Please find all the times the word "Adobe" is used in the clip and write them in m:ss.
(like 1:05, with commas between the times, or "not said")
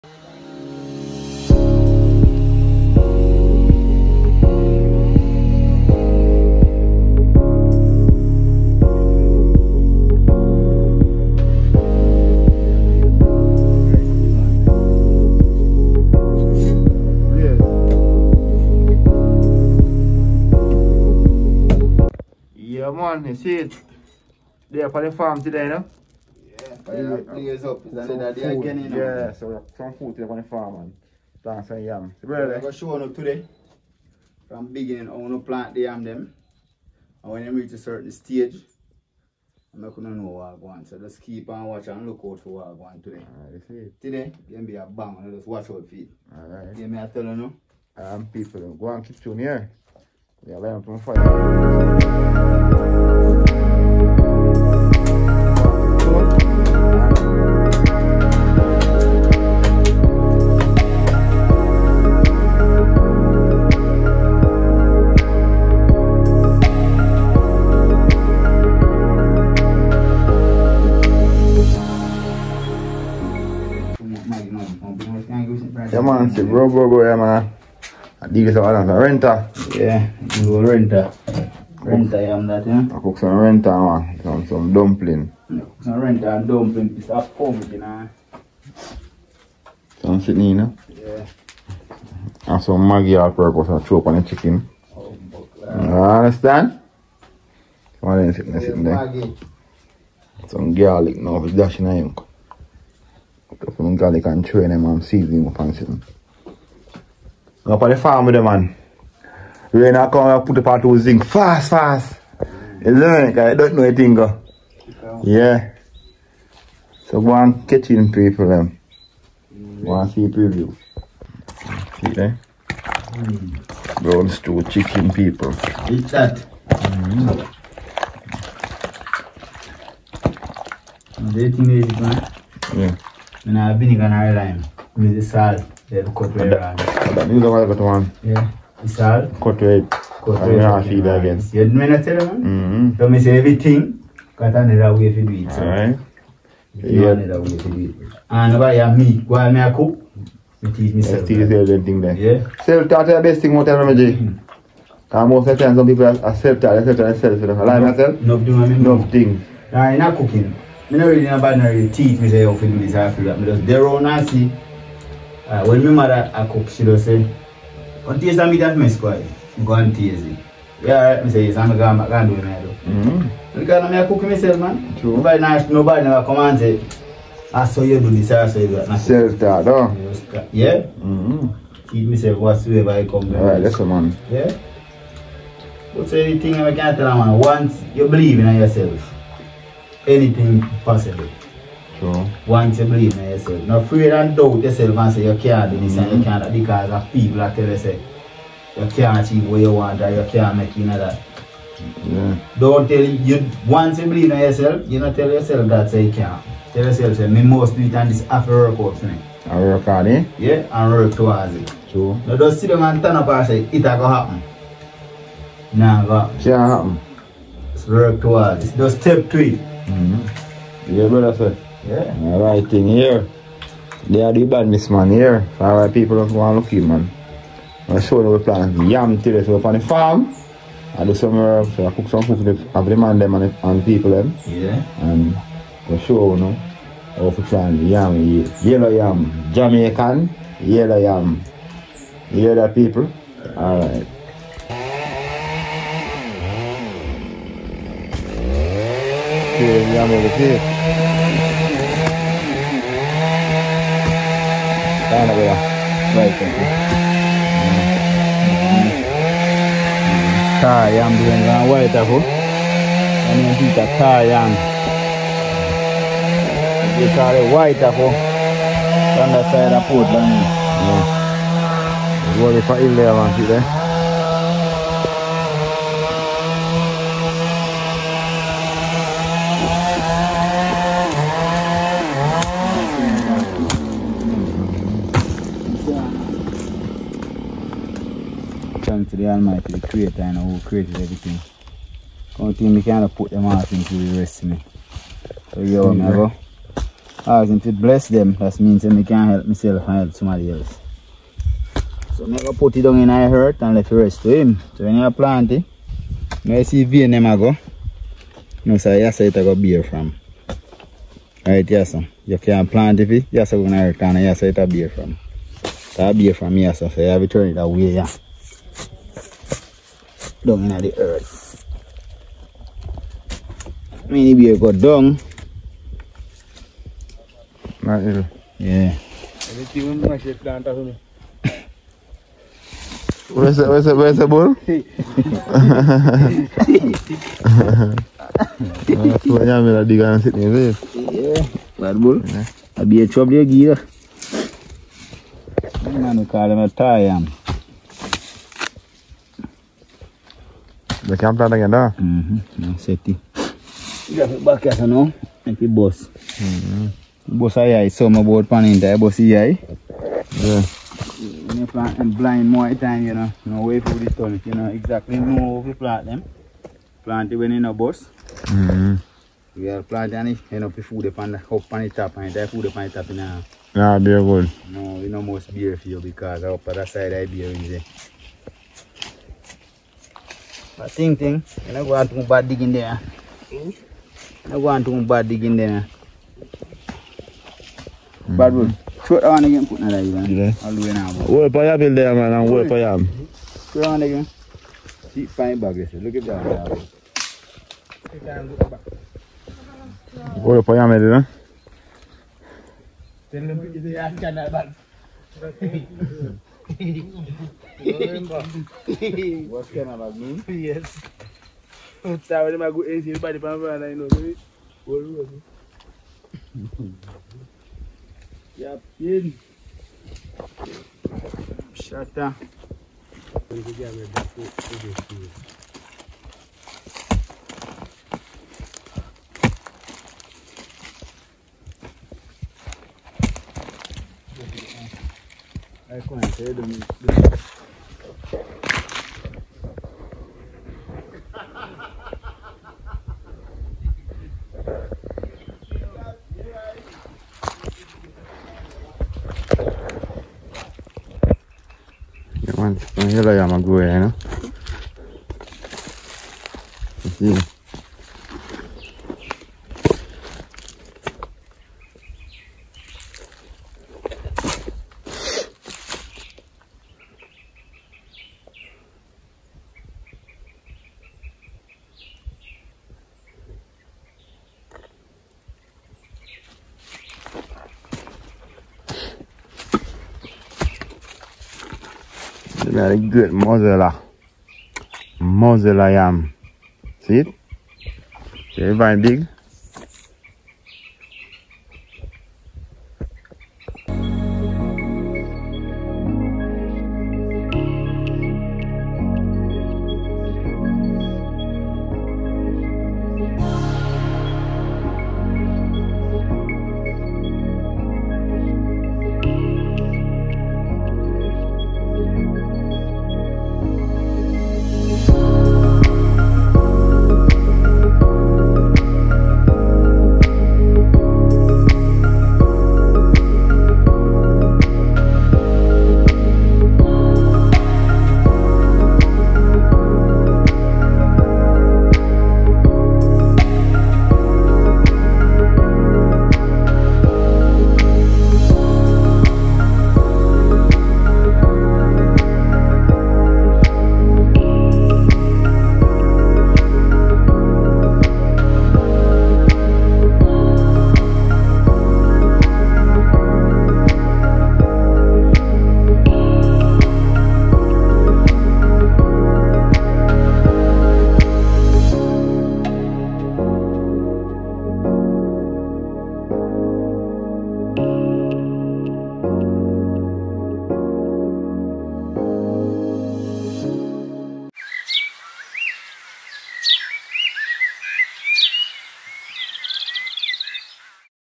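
not said.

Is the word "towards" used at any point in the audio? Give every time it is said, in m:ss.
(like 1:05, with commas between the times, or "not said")
3:31, 3:38.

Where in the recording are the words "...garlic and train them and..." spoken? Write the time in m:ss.
1:43.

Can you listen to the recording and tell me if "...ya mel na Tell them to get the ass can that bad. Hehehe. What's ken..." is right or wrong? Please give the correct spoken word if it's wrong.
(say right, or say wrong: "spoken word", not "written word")
right.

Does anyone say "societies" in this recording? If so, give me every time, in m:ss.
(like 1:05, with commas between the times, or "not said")
not said.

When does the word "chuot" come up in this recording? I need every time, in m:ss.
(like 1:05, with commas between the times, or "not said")
6:29, 6:33.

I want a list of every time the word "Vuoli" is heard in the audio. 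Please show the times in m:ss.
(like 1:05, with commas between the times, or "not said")
4:32.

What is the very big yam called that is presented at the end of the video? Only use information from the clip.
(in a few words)
Muzzler yam.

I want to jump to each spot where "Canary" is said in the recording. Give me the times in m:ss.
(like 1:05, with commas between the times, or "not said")
2:13.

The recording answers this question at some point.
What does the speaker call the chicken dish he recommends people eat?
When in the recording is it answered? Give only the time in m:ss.
2:04.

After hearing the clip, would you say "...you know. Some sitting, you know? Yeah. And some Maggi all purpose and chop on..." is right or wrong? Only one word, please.
right.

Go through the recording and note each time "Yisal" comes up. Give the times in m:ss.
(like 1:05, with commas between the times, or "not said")
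2:18.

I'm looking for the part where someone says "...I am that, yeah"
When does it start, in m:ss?
1:22.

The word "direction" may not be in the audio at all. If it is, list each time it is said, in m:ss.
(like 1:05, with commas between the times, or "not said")
not said.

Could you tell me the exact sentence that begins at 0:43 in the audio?
Right, today, then be a bang and just watch out for it.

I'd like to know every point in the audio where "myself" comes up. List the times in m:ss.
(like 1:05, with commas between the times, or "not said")
2:54, 3:02, 4:59.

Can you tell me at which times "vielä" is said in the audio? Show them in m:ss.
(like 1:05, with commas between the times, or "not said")
4:15.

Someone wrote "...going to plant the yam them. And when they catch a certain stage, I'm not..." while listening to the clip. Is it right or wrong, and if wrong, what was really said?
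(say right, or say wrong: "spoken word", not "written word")
wrong: "reach", not "catch".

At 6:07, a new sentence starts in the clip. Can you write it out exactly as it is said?
Plant it when you know boss.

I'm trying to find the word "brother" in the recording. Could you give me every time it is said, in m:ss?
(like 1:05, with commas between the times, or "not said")
3:41.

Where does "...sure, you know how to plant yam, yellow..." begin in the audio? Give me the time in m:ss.
3:56.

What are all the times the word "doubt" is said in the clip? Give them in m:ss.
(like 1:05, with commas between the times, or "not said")
3:14.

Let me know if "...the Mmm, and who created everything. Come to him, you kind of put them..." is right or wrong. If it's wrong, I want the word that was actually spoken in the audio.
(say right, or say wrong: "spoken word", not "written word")
wrong: "Creator", not "Mmm".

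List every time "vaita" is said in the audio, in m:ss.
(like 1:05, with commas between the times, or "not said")
4:21, 4:27.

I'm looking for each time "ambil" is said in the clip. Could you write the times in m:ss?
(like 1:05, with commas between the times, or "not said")
5:39.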